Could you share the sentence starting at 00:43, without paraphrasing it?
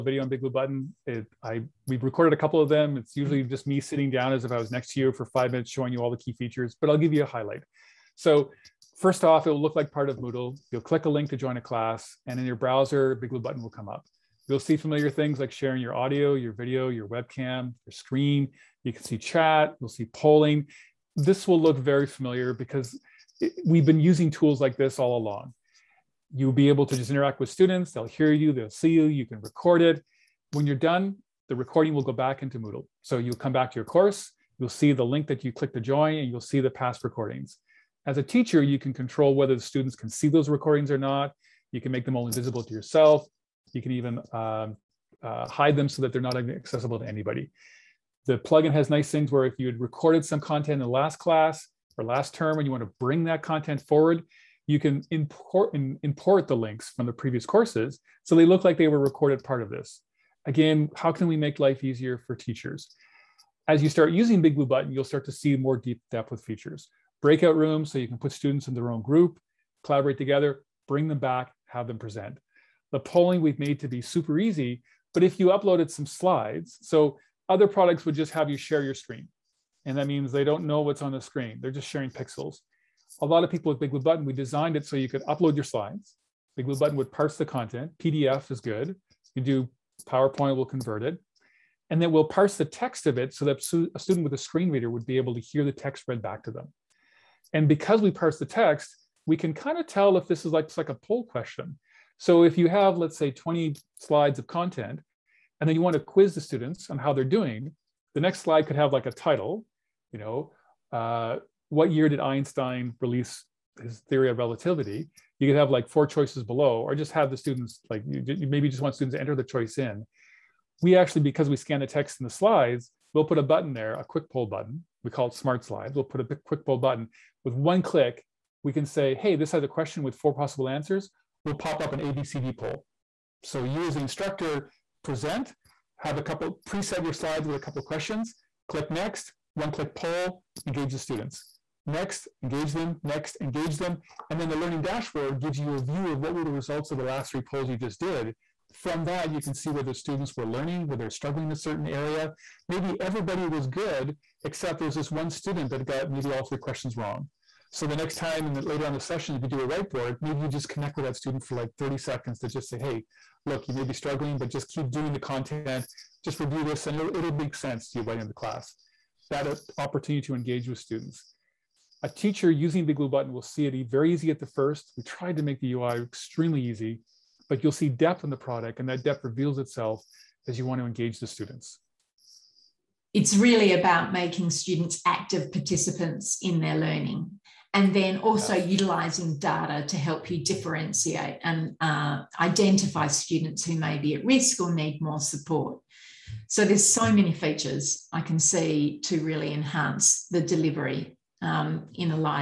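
You can even um, uh, hide them so that they're not accessible to anybody.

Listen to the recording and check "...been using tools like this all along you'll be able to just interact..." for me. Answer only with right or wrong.
right.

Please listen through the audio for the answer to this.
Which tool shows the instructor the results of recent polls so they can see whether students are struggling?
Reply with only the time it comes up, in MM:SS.
02:24.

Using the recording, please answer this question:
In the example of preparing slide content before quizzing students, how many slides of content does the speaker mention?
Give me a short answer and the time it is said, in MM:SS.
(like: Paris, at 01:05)
20, at 01:43.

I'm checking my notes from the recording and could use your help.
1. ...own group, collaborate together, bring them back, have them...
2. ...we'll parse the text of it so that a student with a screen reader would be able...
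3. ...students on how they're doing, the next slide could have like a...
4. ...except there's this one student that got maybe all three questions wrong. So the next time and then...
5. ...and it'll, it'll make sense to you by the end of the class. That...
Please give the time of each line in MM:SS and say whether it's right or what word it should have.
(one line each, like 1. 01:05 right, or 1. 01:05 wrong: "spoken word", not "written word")
1. 01:08 right
2. 01:32 right
3. 01:46 right
4. 02:34 right
5. 02:46 right.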